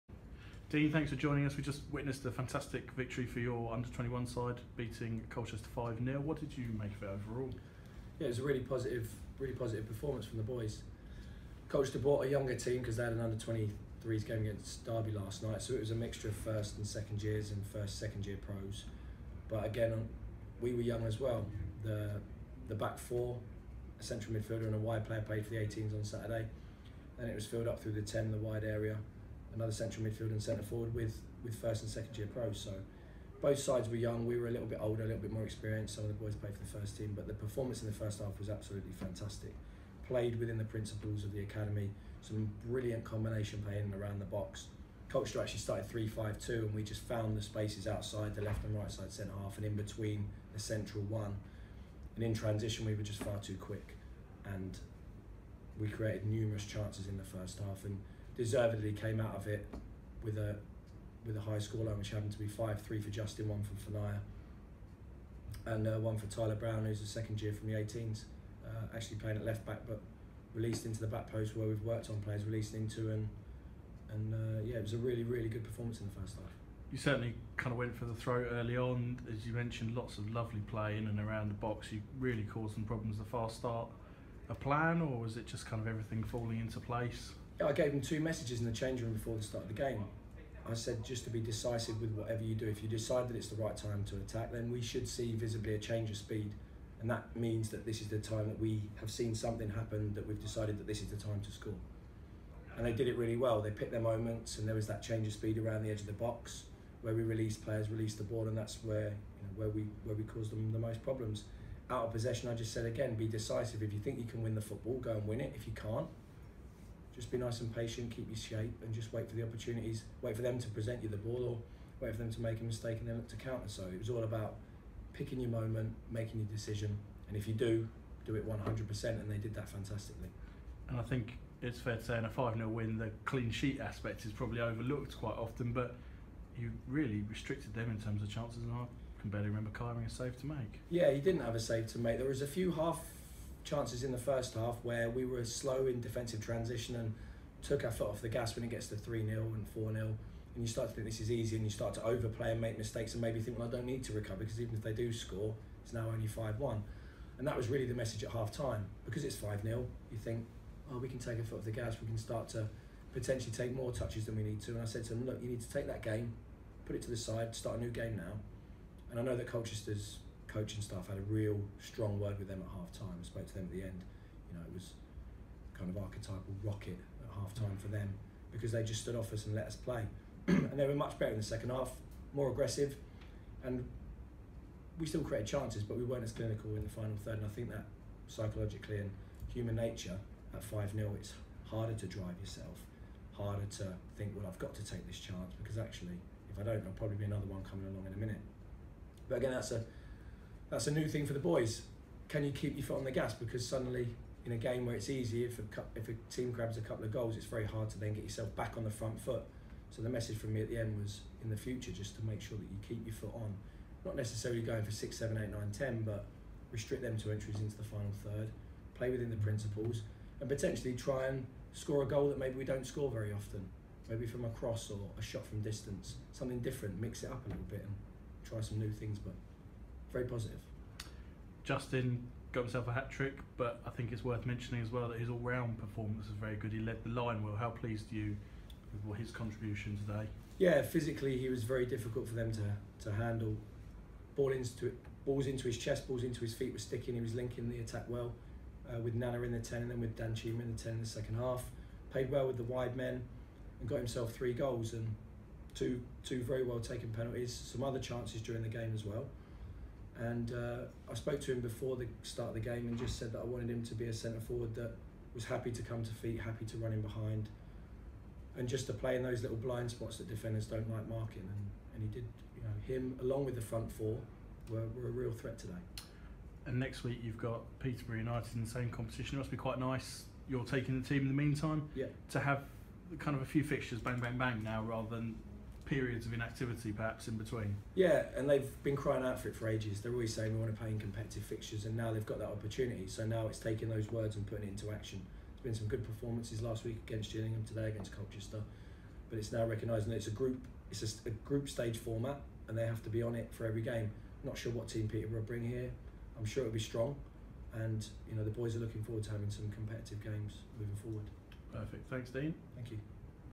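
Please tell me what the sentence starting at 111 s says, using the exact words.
Out of possession, I just said again, be decisive.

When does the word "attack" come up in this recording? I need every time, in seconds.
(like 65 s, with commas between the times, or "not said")
94 s, 247 s.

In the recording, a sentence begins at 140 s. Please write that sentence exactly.
Yeah, he didn't have a save to make.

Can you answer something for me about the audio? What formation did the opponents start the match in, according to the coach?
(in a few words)
3-5-2.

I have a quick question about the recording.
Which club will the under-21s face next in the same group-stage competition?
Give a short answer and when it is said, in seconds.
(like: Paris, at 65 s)
Peterborough United, at 277 s.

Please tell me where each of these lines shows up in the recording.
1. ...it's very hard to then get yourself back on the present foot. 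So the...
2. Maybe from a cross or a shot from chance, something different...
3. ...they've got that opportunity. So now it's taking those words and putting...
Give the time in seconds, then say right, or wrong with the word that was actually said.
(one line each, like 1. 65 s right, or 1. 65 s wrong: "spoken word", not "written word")
1. 207 s wrong: "front", not "present"
2. 224 s wrong: "distance", not "chance"
3. 292 s right.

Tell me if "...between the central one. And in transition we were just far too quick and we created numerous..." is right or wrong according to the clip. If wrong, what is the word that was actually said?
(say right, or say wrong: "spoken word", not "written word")
right.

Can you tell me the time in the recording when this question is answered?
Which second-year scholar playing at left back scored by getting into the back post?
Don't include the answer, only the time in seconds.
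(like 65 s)
66 s.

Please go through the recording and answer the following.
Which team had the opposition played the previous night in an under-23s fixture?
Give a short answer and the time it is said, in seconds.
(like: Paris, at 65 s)
Derby, at 14 s.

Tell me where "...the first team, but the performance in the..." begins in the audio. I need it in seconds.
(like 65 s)
36 s.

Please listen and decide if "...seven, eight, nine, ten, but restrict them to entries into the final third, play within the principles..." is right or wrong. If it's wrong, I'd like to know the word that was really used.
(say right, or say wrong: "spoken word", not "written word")
right.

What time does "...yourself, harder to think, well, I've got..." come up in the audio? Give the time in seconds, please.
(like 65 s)
192 s.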